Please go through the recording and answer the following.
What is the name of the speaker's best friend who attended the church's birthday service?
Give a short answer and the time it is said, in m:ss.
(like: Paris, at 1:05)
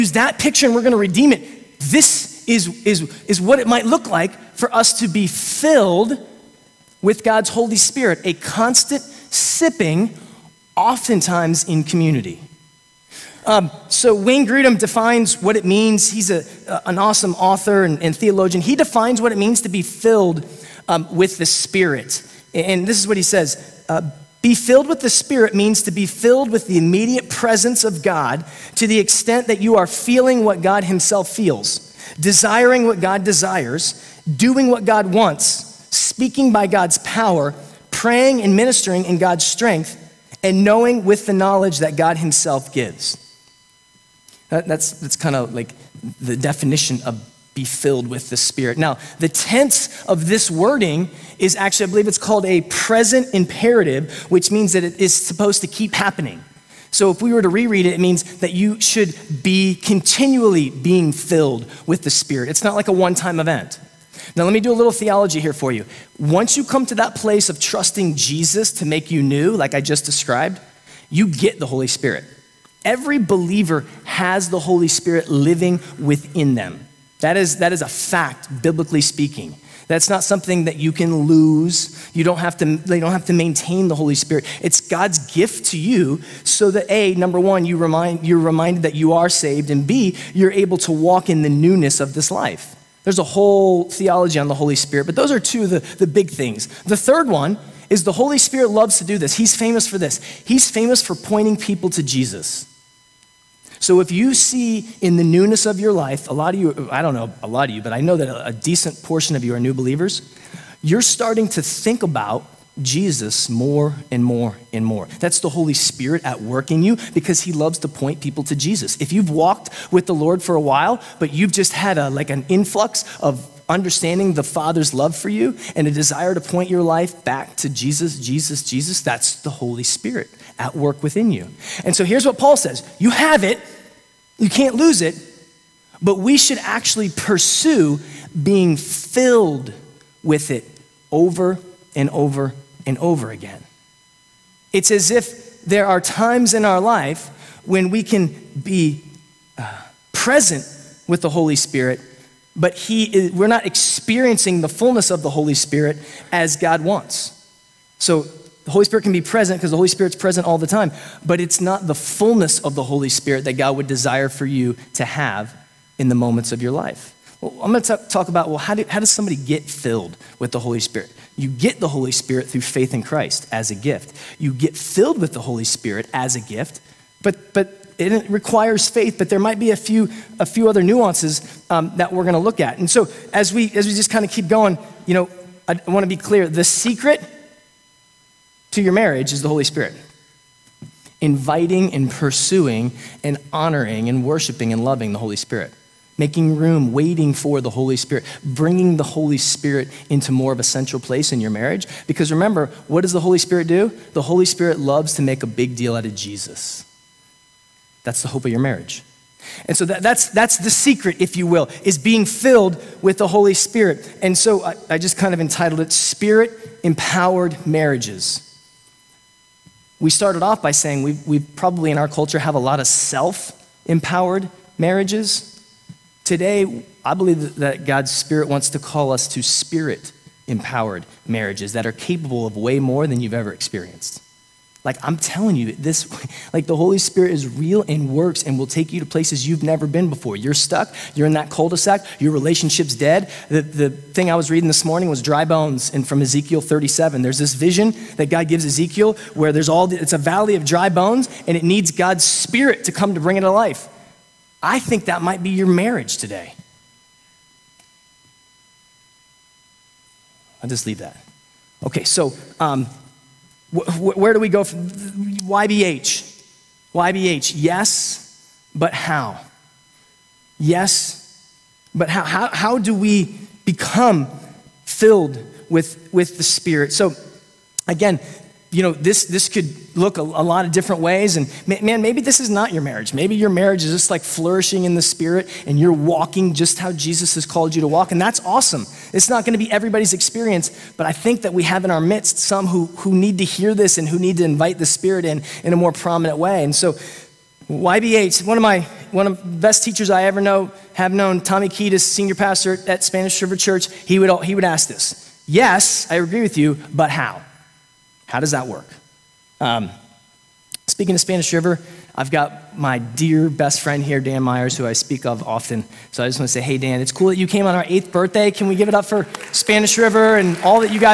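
Dan Myers, at 5:14.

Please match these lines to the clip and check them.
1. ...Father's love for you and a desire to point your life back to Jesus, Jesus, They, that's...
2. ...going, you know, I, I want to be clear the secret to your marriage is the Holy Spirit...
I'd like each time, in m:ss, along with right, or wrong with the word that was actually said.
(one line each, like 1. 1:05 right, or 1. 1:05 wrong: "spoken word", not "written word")
1. 2:04 wrong: "Jesus", not "They"
2. 3:04 right.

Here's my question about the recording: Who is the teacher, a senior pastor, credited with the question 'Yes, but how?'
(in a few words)
Tommy Kiedis.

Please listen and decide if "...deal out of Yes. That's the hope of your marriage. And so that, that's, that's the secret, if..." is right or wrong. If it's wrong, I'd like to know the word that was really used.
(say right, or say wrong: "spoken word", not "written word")
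wrong: "Jesus", not "Yes".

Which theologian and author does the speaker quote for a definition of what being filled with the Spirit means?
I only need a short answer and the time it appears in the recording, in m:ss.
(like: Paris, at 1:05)
Wayne Grudem, at 0:14.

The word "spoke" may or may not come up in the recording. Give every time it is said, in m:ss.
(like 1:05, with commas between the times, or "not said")
not said.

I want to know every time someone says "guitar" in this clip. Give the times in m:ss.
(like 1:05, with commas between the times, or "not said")
not said.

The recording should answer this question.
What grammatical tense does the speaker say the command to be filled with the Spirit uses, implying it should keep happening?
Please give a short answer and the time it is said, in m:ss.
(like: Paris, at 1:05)
present imperative, at 0:52.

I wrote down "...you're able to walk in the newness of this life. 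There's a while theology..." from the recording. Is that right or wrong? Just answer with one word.
wrong.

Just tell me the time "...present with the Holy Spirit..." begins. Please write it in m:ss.
2:30.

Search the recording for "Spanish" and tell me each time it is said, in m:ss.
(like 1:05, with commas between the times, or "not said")
5:03, 5:11, 5:19.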